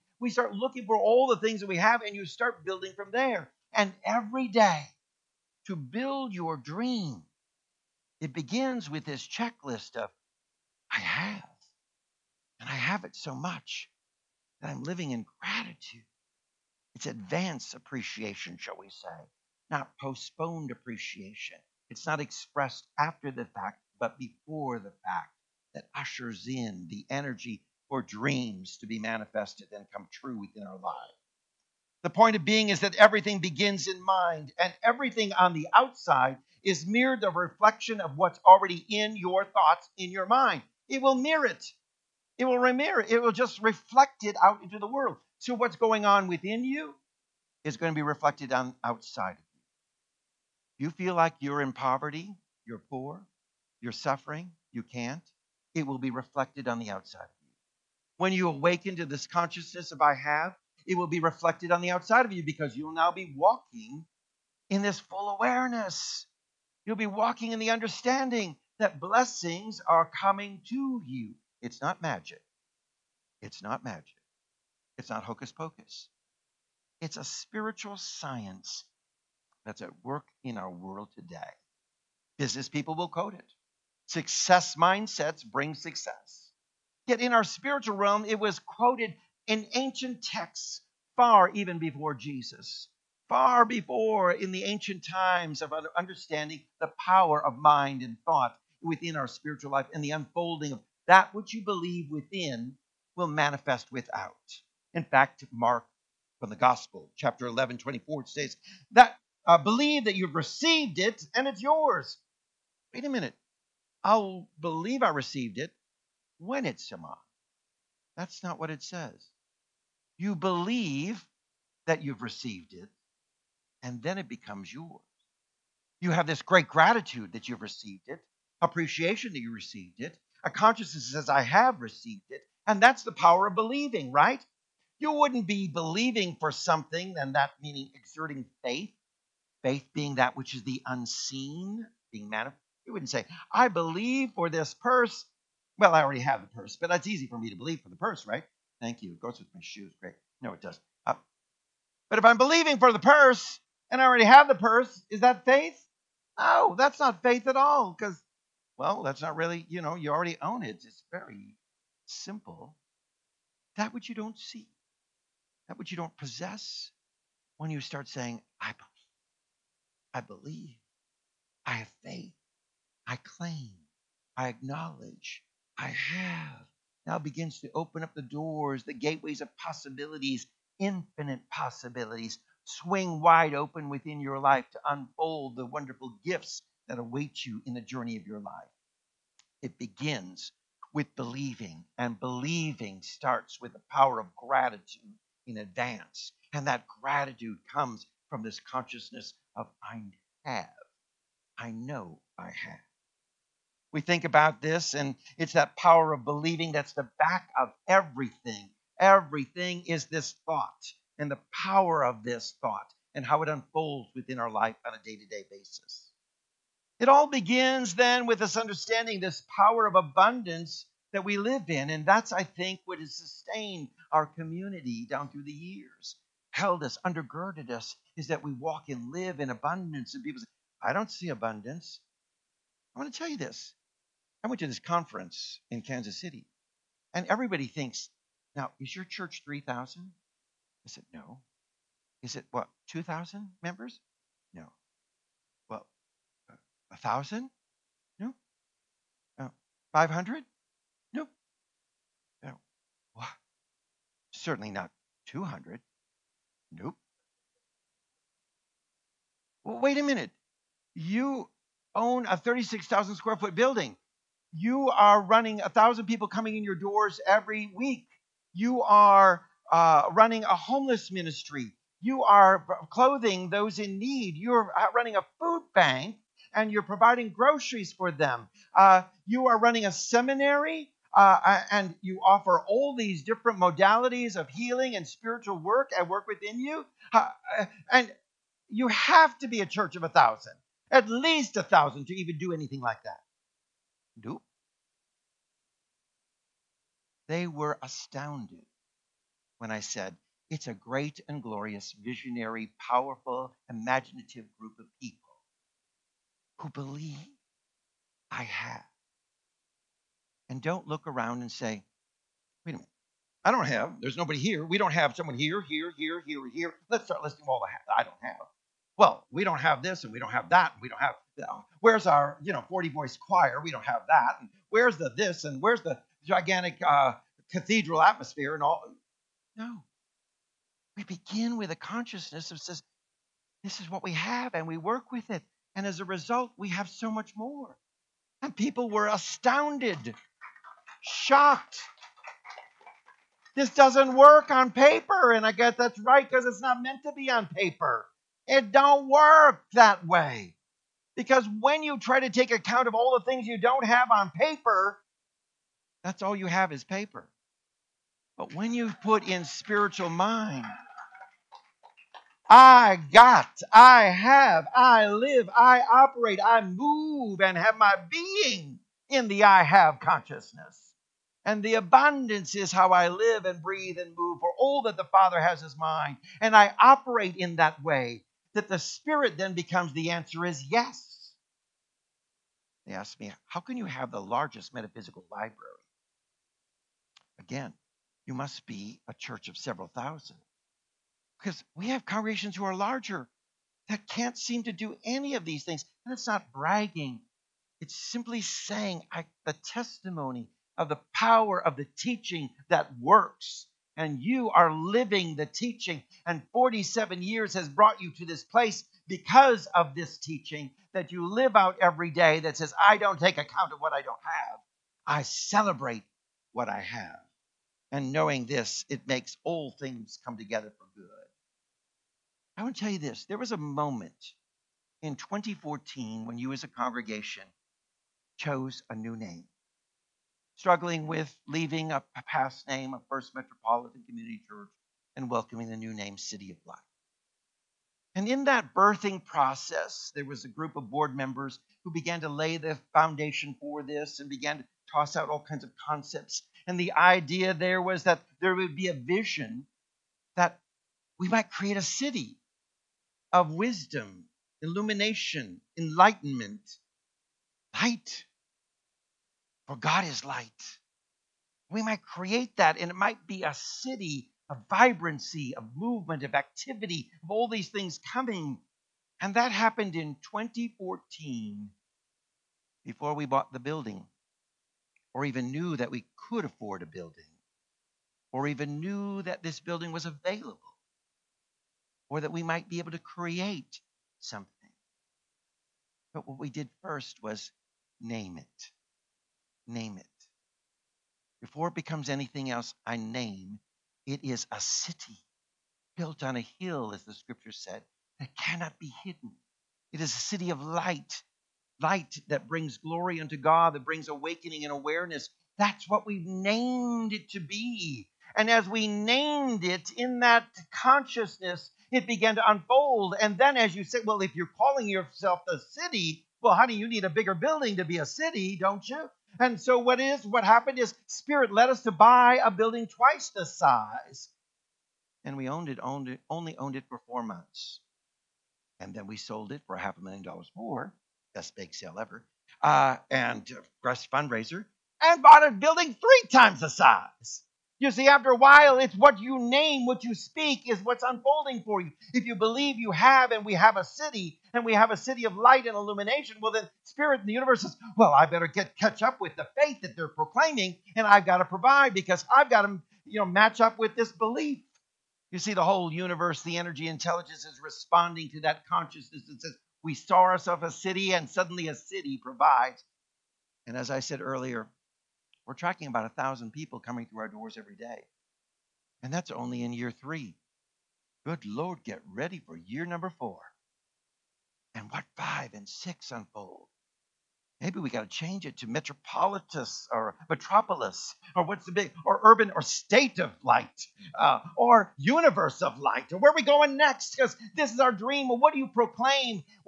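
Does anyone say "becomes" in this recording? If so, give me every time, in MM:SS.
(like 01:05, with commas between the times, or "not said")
02:04, 06:19, 08:11.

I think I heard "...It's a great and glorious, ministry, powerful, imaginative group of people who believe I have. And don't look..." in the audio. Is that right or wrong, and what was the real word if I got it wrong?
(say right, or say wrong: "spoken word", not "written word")
wrong: "visionary", not "ministry".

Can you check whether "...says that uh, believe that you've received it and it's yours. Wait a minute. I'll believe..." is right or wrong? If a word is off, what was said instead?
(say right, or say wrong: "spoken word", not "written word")
right.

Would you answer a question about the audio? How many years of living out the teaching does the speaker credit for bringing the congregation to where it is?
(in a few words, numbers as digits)
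47.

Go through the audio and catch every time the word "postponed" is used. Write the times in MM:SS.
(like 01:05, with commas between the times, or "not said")
00:19.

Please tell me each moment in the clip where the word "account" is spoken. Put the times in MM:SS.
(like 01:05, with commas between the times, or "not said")
05:52, 06:53.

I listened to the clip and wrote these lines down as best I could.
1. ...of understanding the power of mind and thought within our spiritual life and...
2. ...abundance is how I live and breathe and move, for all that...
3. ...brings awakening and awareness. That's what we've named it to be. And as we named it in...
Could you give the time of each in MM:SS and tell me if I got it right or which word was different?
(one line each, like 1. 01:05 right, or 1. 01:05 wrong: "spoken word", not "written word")
1. 01:35 right
2. 06:11 right
3. 08:23 right.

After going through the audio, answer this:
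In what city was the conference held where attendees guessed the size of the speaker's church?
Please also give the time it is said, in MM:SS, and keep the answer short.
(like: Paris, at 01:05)
Kansas City, at 03:55.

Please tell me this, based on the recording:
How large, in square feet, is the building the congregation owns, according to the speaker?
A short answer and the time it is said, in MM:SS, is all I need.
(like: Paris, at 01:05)
36,000 square feet, at 04:22.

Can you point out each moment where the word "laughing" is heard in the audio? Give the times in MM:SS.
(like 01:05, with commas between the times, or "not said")
not said.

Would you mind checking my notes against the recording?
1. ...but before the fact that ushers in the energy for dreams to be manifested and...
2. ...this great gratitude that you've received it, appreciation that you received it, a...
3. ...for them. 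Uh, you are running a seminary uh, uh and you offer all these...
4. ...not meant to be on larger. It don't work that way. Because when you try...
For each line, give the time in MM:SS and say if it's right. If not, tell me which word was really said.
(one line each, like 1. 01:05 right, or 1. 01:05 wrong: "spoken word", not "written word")
1. 00:23 right
2. 02:06 right
3. 04:37 right
4. 05:46 wrong: "paper", not "larger".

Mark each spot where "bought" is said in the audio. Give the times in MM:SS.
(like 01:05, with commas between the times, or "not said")
07:53, 08:55.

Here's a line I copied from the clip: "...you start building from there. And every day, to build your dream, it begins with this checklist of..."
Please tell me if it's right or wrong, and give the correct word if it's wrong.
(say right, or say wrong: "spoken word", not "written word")
right.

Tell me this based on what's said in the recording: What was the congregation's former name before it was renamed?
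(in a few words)
First Metropolitan Community Church.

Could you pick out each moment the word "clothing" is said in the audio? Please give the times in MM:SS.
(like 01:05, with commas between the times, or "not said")
04:32.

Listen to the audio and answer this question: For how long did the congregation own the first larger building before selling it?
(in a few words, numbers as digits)
four months.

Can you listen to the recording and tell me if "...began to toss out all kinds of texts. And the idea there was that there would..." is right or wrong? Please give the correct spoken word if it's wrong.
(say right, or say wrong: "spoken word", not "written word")
wrong: "concepts", not "texts".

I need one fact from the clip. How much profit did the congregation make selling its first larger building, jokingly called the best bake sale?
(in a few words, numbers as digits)
half a million dollars.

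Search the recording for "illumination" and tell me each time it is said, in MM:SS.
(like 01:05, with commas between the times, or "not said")
07:34, 09:05.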